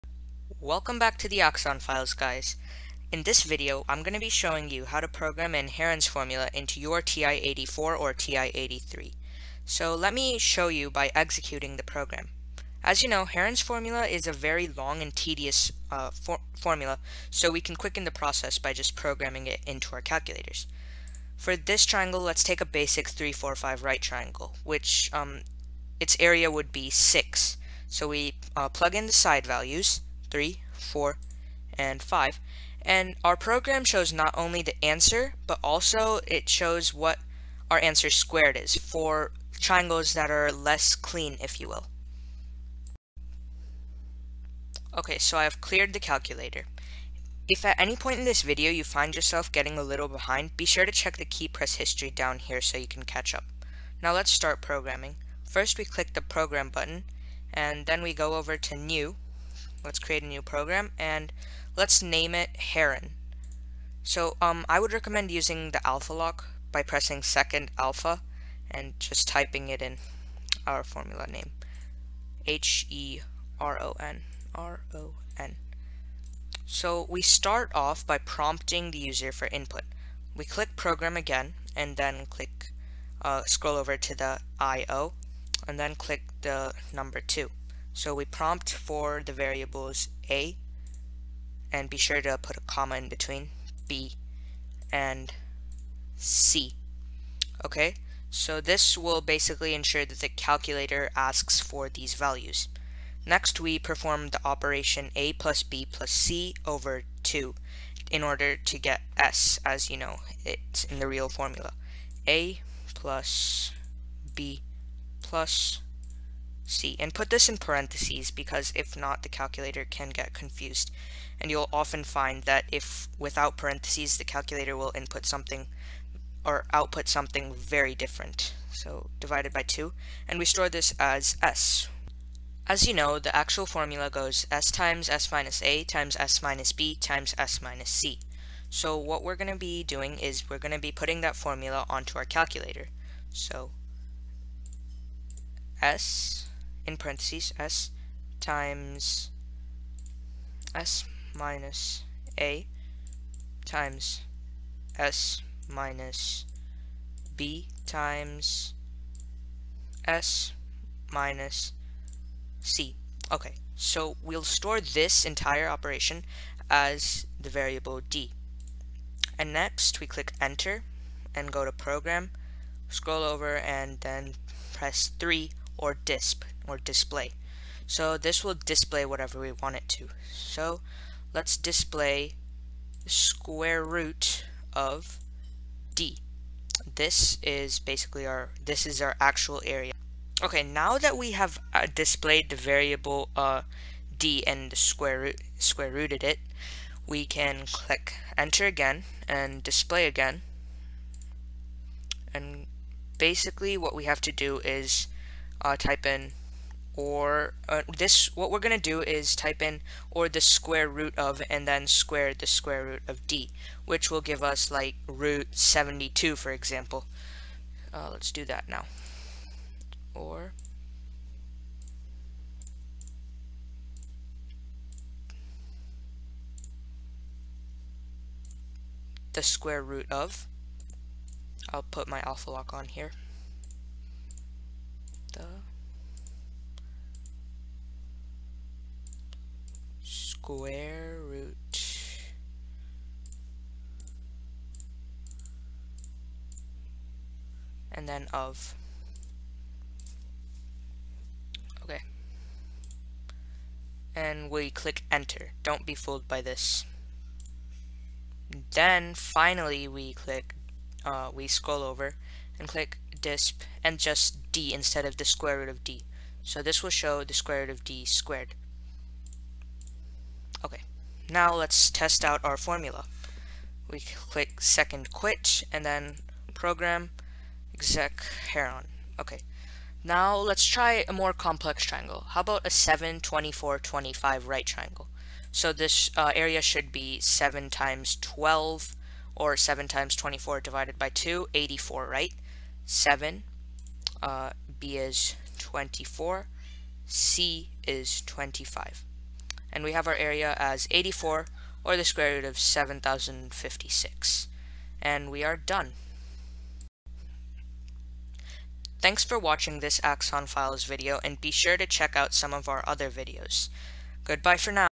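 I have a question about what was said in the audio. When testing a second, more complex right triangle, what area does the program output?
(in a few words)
84.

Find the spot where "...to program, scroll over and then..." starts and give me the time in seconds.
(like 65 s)
171 s.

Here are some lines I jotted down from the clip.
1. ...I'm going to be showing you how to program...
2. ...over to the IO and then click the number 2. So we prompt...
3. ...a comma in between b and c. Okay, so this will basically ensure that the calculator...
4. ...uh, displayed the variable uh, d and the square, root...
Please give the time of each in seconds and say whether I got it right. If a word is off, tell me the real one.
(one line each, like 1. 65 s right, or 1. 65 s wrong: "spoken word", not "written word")
1. 3 s right
2. 83 s right
3. 92 s right
4. 191 s right.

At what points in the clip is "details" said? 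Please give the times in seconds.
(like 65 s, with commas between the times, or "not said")
not said.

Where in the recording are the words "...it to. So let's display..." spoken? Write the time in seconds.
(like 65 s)
179 s.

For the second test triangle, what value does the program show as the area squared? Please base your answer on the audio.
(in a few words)
7056.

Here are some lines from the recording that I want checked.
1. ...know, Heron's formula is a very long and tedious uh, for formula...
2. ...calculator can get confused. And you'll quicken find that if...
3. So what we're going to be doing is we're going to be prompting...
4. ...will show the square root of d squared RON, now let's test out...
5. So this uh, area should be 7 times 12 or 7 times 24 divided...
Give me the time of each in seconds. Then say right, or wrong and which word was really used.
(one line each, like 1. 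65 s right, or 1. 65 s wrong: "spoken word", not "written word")
1. 13 s right
2. 119 s wrong: "often", not "quicken"
3. 138 s wrong: "putting", not "prompting"
4. 266 s wrong: "Okay", not "RON"
5. 285 s right.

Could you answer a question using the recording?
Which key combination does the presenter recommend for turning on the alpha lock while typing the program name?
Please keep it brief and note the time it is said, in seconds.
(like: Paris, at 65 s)
second alpha, at 67 s.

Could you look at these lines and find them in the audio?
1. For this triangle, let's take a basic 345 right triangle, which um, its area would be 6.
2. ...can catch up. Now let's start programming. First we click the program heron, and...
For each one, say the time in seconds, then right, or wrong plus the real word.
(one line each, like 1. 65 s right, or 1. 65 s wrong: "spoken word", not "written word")
1. 21 s right
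2. 52 s wrong: "button", not "heron".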